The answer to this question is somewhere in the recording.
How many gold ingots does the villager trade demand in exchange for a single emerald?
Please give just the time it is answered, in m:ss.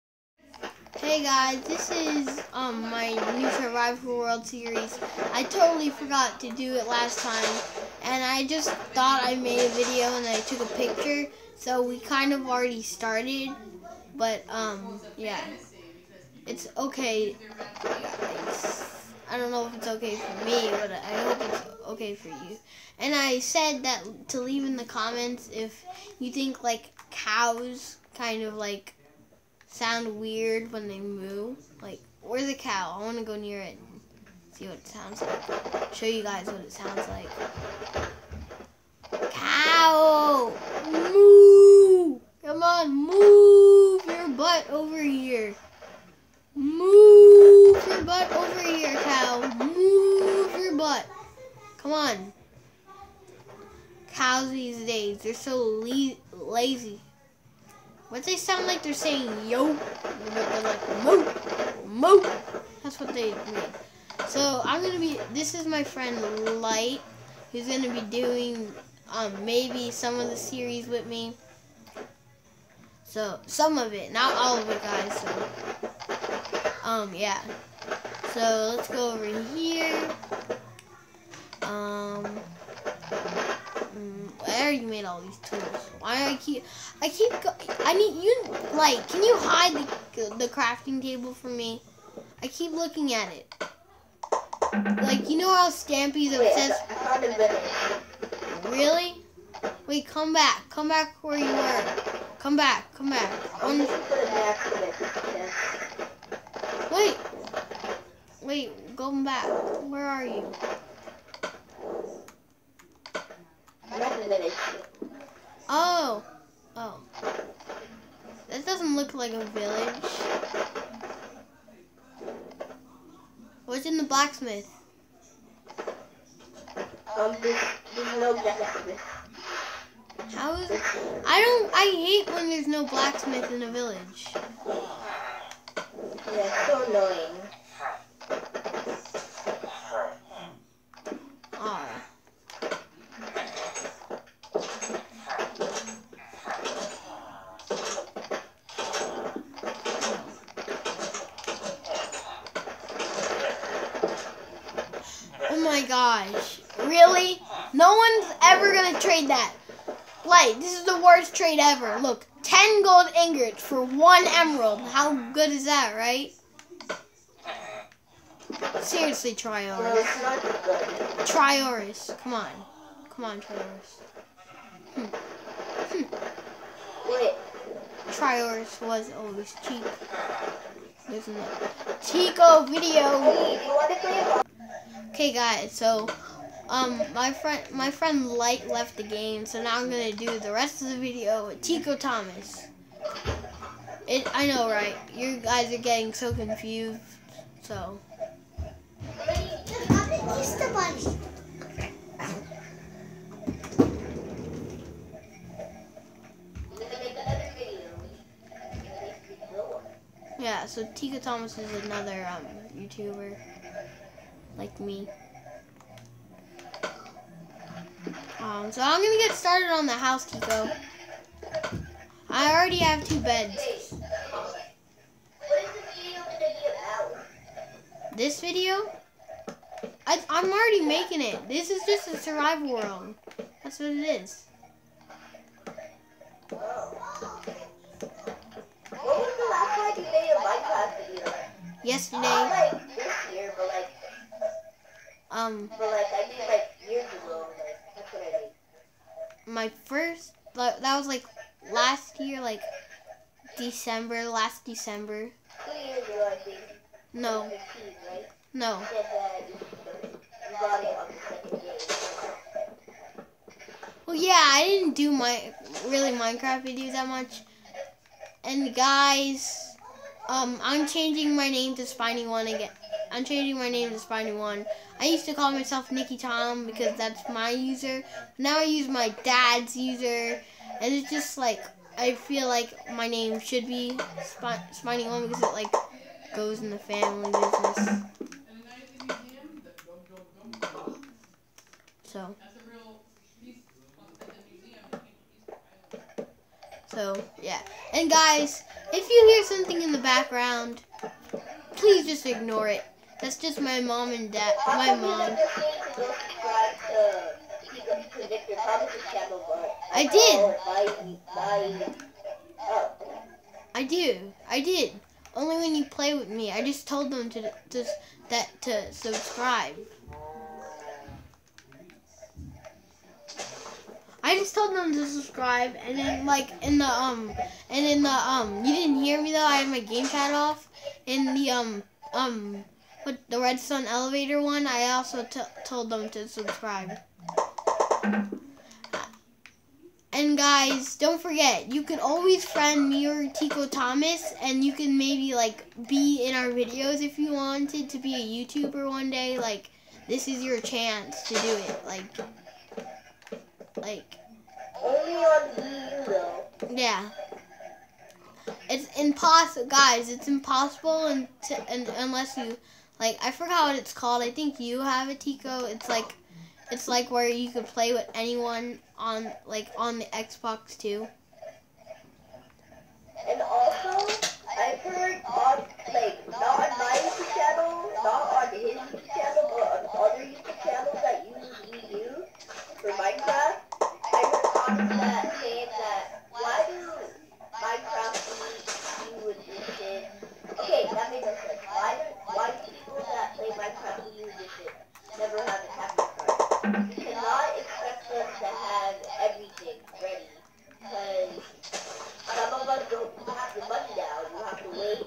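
2:42.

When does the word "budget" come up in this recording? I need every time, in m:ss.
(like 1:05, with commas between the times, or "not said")
not said.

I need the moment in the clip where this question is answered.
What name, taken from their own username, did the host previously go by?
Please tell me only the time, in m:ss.
4:35.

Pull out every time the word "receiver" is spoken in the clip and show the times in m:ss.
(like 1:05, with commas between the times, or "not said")
not said.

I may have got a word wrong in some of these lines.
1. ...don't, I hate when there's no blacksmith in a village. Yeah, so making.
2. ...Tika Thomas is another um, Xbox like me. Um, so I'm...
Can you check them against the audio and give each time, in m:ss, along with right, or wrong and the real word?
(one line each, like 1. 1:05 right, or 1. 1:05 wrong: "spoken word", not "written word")
1. 2:11 wrong: "annoying", not "making"
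2. 3:30 wrong: "YouTuber", not "Xbox".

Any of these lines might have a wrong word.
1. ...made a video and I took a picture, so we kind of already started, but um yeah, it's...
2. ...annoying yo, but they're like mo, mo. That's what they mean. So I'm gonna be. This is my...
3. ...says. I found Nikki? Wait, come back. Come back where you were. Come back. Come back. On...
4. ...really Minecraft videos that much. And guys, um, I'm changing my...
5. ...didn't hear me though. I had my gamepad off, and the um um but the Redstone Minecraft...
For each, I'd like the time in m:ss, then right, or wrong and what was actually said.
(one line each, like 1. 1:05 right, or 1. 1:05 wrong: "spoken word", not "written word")
1. 0:09 right
2. 0:58 wrong: "saying", not "annoying"
3. 1:36 wrong: "Really", not "Nikki"
4. 4:25 right
5. 5:28 wrong: "Elevator", not "Minecraft".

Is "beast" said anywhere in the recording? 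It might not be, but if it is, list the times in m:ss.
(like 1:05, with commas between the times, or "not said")
not said.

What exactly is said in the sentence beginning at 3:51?
This is just a survival world.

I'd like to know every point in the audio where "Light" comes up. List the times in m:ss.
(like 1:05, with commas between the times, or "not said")
1:06, 3:08.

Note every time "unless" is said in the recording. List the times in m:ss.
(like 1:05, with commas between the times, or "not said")
6:01.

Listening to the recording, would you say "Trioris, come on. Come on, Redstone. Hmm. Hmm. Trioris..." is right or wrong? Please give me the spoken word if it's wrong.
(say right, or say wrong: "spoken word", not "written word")
wrong: "Trioris", not "Redstone".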